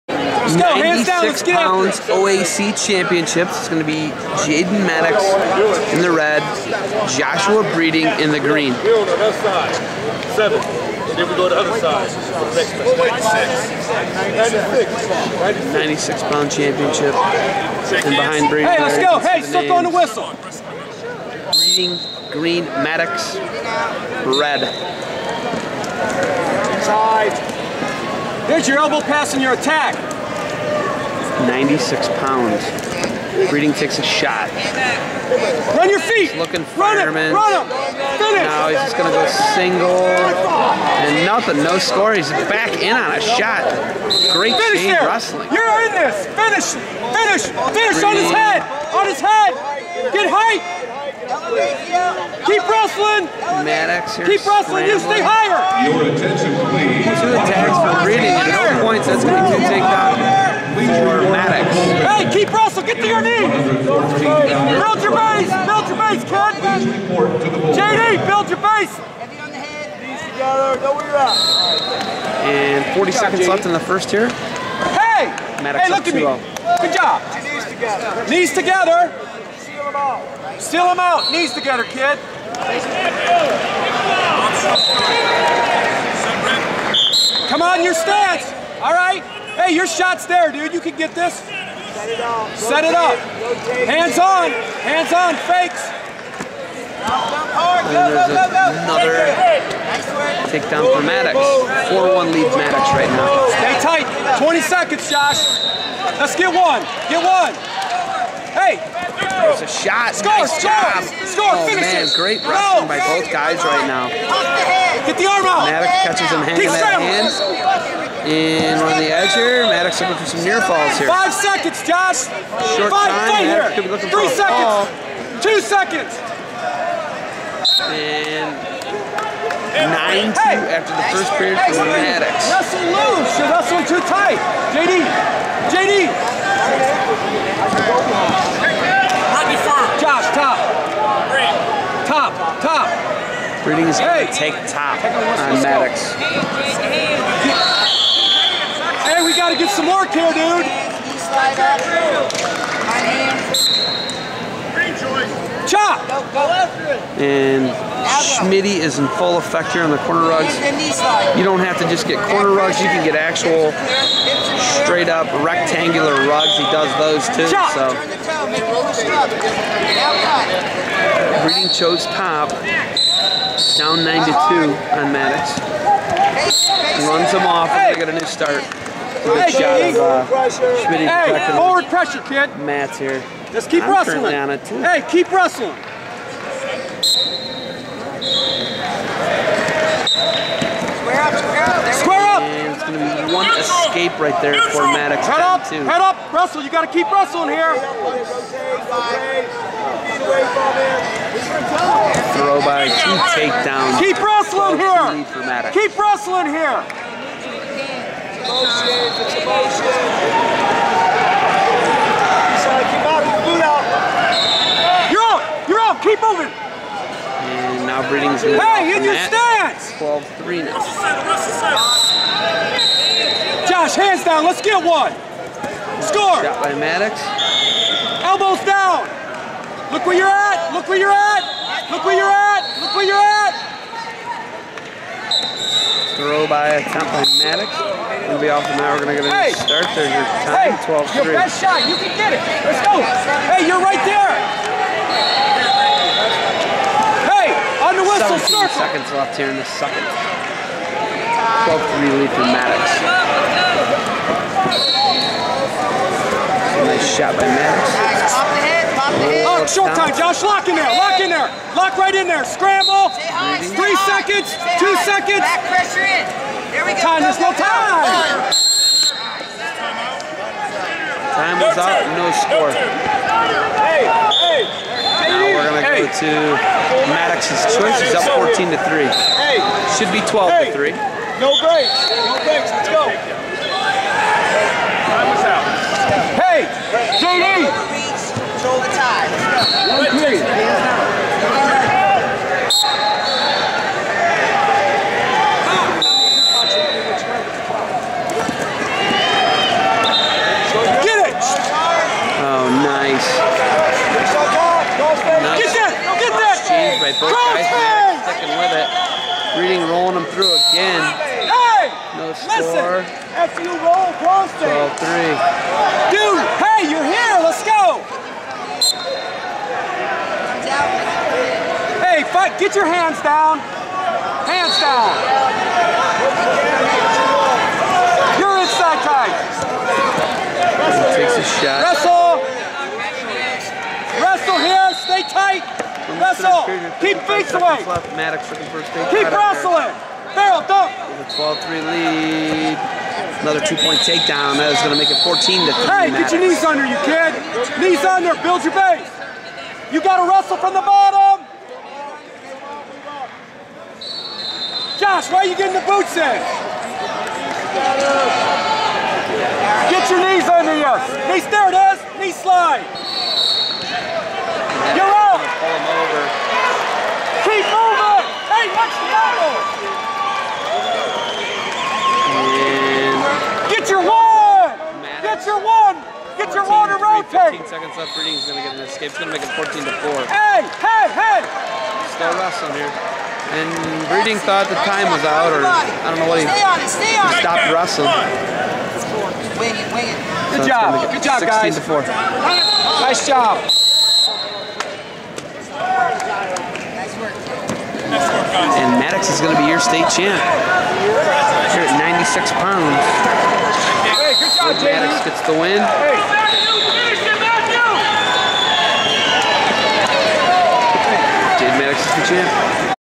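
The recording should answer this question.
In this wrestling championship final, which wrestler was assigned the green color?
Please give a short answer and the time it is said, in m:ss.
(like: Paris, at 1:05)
Joshua Breeding, at 0:07.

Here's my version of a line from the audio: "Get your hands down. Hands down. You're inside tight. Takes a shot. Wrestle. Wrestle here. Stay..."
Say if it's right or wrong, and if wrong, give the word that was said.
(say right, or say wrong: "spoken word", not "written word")
right.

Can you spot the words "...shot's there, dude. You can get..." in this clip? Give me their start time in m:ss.
1:29.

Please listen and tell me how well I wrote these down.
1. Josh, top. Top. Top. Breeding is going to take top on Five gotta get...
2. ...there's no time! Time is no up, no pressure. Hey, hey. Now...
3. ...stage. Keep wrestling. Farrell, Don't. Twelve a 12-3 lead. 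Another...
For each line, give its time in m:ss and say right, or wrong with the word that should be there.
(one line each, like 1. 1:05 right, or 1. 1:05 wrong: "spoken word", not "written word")
1. 2:19 wrong: "Mattox", not "Five"
2. 4:27 wrong: "score", not "pressure"
3. 5:38 right.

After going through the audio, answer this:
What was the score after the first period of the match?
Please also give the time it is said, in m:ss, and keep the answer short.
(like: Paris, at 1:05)
9-2, at 2:09.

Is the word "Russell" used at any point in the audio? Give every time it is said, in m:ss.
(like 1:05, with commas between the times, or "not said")
1:02, 3:16.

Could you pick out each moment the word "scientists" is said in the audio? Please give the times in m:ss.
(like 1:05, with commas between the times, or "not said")
not said.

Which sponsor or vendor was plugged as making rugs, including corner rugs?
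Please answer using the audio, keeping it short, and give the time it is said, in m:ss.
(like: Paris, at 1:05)
Schmitty, at 2:38.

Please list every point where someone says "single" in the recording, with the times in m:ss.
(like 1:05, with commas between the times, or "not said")
0:39.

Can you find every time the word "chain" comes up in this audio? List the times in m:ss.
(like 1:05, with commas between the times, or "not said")
0:44.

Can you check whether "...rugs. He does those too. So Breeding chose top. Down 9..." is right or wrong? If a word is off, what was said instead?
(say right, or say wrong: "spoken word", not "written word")
right.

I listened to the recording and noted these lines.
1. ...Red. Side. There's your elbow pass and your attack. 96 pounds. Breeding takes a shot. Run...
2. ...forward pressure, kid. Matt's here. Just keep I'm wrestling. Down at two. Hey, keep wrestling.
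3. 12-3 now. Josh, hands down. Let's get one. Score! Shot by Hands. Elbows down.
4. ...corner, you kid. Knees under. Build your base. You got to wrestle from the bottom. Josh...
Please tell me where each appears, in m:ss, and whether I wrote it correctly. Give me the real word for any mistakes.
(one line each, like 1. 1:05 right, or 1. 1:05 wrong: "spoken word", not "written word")
1. 0:24 right
2. 3:01 right
3. 3:39 wrong: "Mattox", not "Hands"
4. 5:46 wrong: "under", not "corner".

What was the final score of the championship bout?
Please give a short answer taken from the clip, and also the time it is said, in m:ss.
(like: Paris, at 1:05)
16 to 4, at 6:31.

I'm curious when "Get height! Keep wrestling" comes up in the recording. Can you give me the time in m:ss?
0:50.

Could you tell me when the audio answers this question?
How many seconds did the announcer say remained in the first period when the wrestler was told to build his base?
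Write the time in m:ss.
1:12.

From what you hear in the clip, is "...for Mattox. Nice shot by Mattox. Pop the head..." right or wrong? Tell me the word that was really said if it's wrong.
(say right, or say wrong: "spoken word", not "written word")
right.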